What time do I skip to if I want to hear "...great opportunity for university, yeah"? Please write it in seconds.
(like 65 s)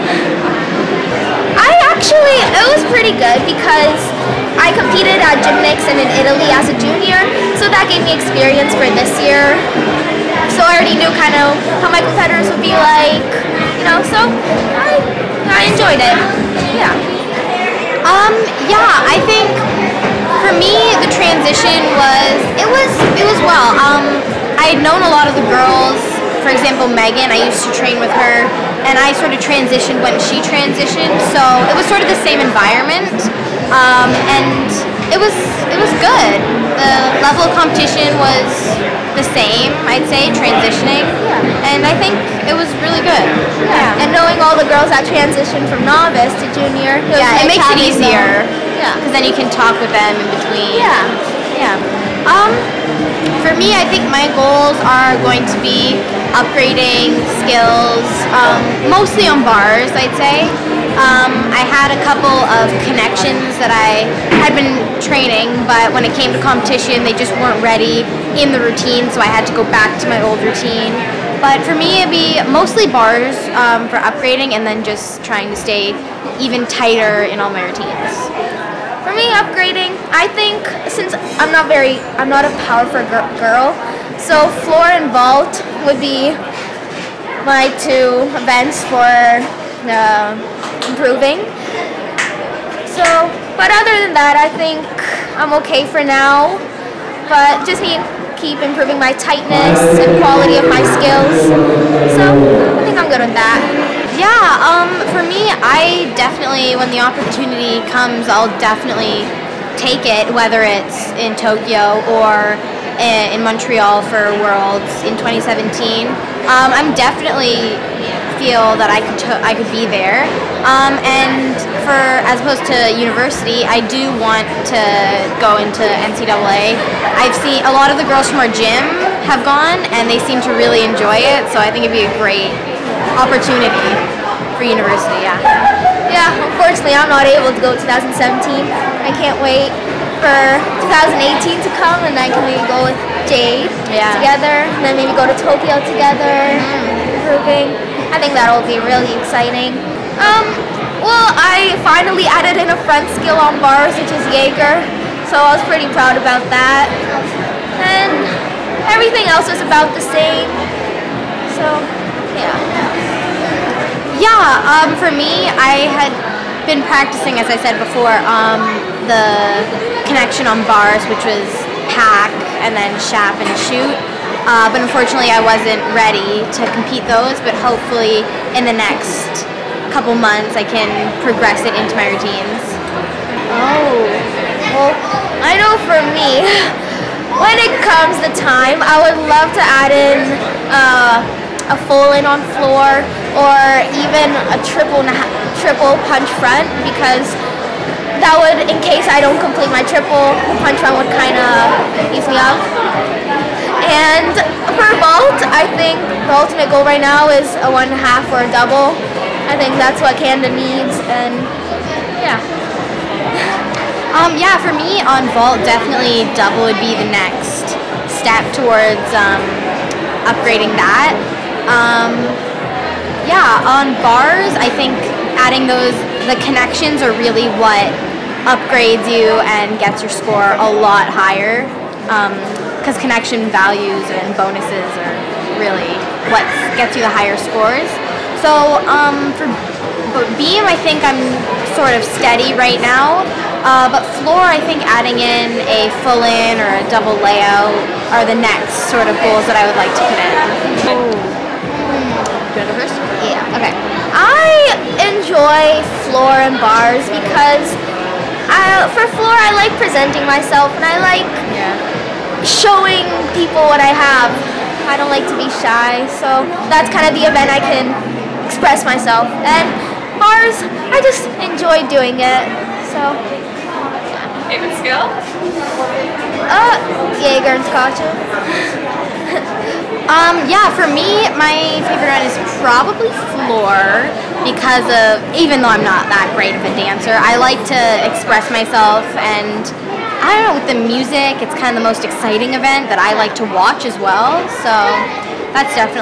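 132 s.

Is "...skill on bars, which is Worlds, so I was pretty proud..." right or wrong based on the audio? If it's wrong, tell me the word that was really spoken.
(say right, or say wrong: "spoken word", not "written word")
wrong: "Jaeger", not "Worlds".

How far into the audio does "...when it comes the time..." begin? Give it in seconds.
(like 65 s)
187 s.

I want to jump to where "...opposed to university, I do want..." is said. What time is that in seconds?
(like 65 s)
122 s.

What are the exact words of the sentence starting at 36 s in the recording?
The level of competition was the same, I'd say, transitioning, yeah.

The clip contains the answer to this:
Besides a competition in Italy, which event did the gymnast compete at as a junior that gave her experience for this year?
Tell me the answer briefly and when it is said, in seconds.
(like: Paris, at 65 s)
Gymnix, at 5 s.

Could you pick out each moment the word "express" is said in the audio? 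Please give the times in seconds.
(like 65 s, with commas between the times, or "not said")
268 s, 288 s.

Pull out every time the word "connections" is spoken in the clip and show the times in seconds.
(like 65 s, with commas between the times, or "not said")
62 s, 170 s, 226 s, 233 s.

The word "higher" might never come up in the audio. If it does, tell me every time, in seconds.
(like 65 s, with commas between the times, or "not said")
231 s, 237 s.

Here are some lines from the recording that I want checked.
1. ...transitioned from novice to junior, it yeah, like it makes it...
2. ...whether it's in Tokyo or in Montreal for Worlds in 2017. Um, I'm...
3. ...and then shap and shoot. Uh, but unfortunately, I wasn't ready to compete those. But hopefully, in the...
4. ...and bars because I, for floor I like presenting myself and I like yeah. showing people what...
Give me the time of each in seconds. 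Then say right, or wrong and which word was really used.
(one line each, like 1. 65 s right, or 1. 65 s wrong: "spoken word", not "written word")
1. 45 s right
2. 110 s right
3. 172 s right
4. 256 s right.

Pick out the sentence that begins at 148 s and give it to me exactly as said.
I think that'll be really exciting.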